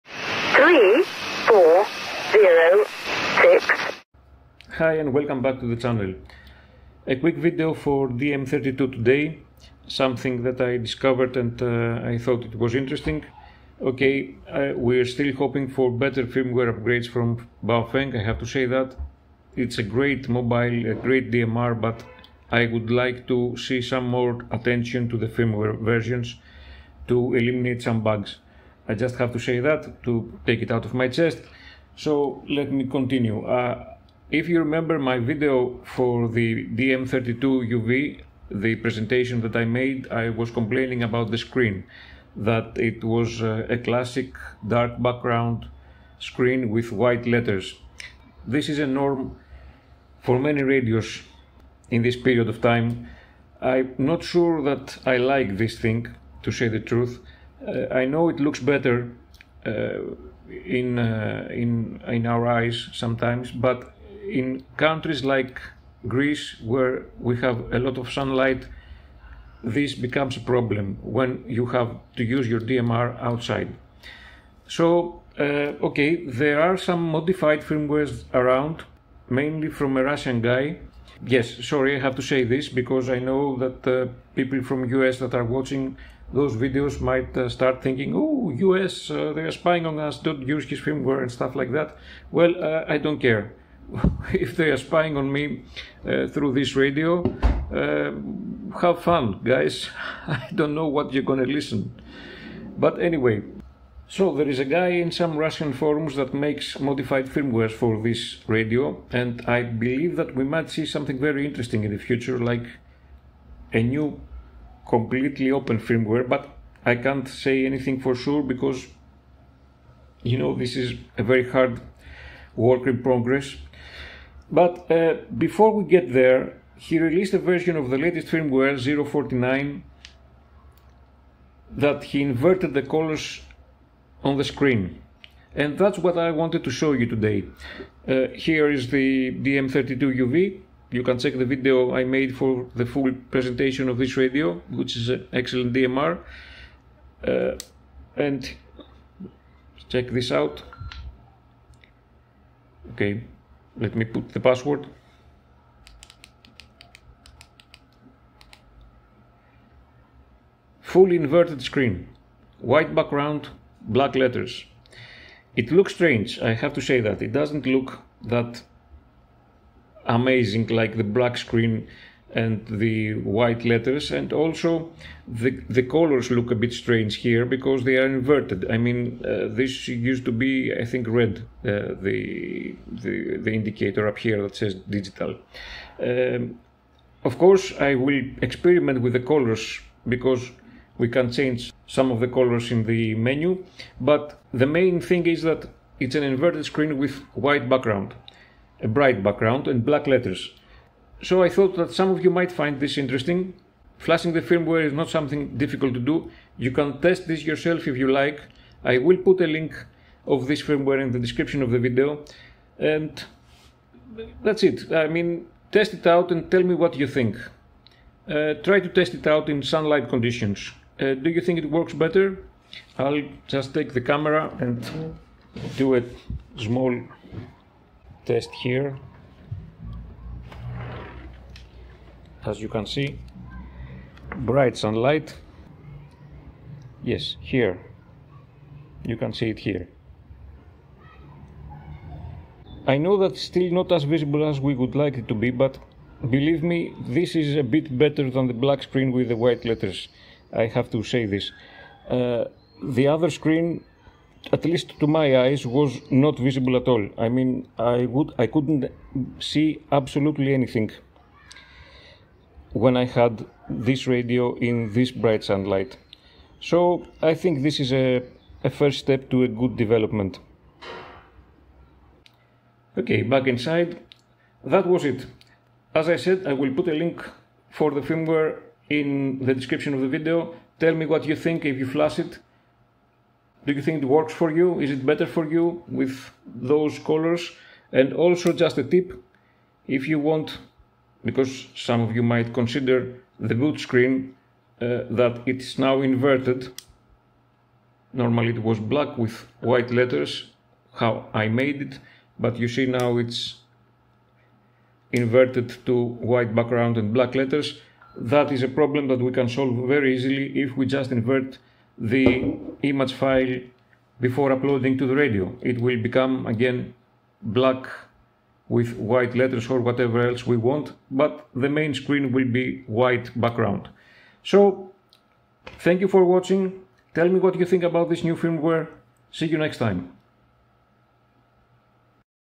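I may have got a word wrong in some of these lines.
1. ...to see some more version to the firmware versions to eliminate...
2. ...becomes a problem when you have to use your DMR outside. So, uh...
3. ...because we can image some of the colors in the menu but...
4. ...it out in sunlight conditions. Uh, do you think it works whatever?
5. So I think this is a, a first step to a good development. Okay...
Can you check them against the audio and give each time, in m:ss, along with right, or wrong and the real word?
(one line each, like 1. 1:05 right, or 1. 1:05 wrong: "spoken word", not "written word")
1. 0:23 wrong: "attention", not "version"
2. 1:09 right
3. 3:10 wrong: "change", not "image"
4. 3:39 wrong: "better", not "whatever"
5. 4:26 right.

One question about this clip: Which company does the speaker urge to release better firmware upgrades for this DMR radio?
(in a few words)
Baofeng.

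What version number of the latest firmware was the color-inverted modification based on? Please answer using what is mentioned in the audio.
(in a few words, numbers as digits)
049.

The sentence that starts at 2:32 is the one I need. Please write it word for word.
Okay, let me put the password.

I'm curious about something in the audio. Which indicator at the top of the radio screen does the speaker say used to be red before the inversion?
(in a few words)
digital.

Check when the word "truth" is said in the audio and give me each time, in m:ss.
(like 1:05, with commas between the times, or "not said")
0:56.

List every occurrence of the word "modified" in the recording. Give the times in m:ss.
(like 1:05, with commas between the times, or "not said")
1:17, 1:46.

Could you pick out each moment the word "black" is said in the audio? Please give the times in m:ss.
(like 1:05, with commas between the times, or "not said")
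2:43, 2:51, 3:19, 4:08, 4:58, 5:07, 5:17.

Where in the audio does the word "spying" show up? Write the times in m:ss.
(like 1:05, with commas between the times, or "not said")
1:29, 1:34.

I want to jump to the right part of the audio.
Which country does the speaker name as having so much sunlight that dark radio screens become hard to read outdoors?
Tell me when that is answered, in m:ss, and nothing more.
1:06.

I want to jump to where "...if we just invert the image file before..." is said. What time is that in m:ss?
5:10.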